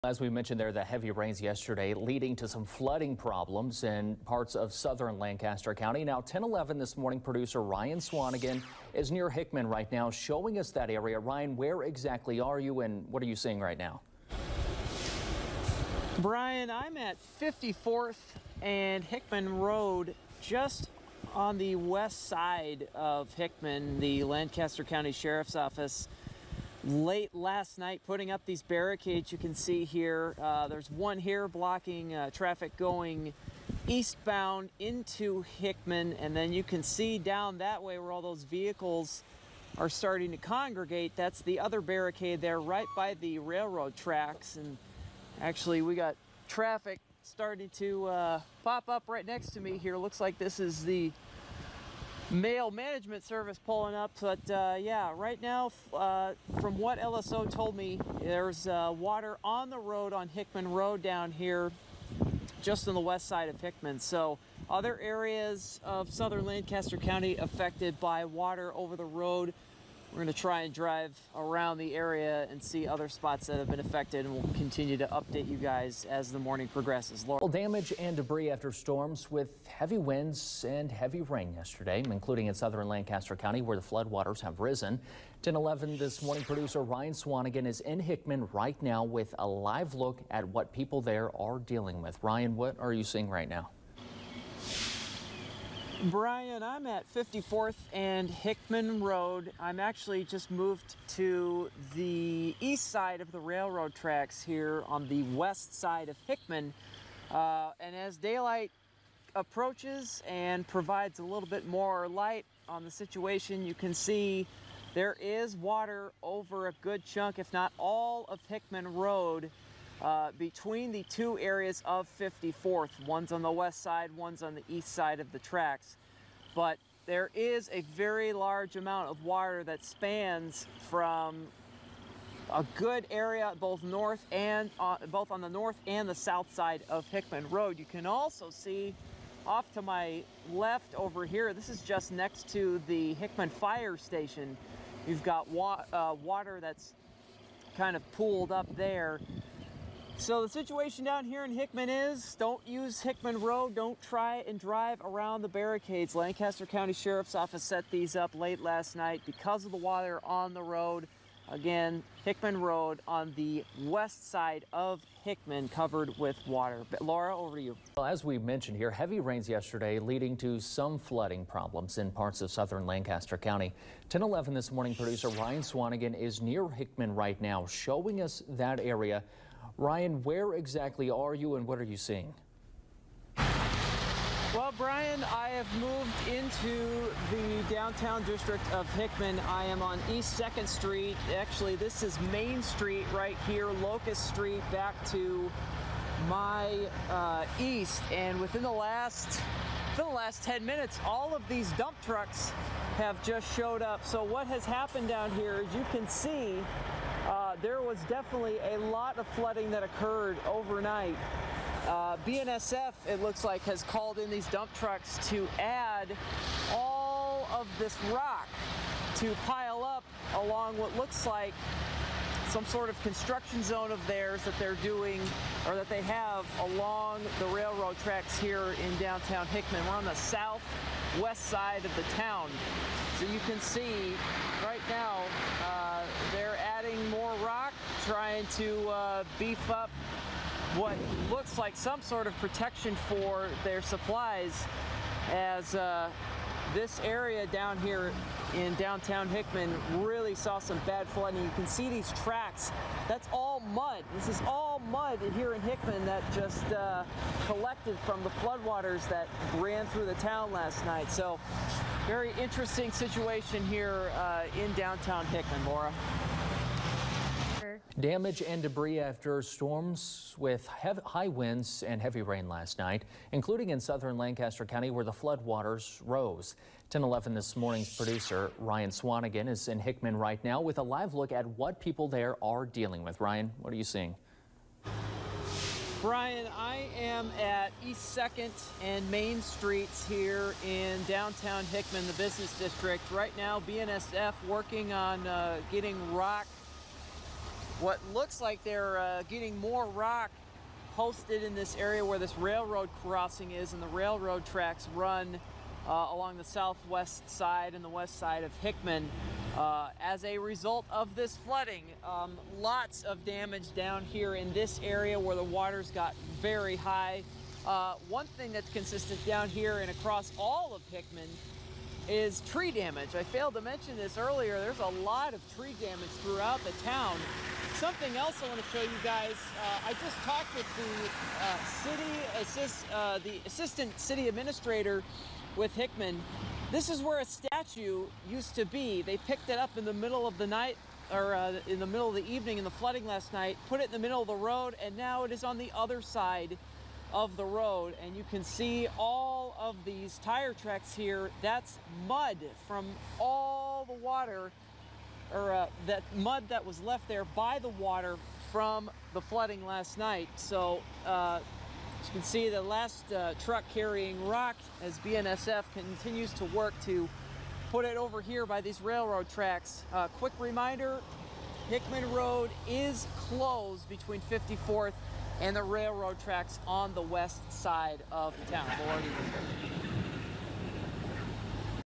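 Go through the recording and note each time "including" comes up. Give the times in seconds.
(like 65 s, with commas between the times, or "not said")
82 s, 273 s.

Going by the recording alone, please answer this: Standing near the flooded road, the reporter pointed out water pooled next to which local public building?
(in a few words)
Hickman Fire Station.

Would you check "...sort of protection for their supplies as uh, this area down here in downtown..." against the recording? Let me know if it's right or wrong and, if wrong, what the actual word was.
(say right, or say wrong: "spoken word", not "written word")
right.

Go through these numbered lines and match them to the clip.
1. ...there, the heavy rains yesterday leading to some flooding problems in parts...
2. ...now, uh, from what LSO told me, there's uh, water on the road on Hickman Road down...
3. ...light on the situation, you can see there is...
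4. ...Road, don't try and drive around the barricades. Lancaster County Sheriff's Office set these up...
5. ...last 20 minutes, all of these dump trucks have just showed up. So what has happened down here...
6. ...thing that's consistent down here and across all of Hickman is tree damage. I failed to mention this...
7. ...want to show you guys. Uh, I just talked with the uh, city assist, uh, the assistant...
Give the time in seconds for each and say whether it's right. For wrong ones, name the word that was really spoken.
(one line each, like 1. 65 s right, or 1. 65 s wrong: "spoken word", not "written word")
1. 0 s right
2. 55 s right
3. 112 s right
4. 153 s right
5. 200 s wrong: "10", not "20"
6. 318 s right
7. 328 s right.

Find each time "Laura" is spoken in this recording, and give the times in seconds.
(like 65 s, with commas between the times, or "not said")
77 s, 167 s, 265 s, 378 s.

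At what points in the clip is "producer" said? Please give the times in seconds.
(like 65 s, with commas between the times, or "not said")
7 s, 86 s, 174 s, 277 s.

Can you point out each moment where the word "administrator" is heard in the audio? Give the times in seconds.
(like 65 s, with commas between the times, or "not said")
334 s.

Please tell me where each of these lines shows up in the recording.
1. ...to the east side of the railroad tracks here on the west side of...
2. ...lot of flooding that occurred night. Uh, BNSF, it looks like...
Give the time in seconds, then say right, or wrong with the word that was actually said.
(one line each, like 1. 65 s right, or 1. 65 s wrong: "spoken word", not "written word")
1. 101 s right
2. 208 s wrong: "overnight", not "night".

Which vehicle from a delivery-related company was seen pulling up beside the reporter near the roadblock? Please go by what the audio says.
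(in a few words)
mail management service.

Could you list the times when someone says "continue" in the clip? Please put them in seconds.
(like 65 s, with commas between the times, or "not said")
74 s, 365 s.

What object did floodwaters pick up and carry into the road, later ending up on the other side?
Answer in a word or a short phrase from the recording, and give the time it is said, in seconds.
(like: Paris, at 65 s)
a statue, at 337 s.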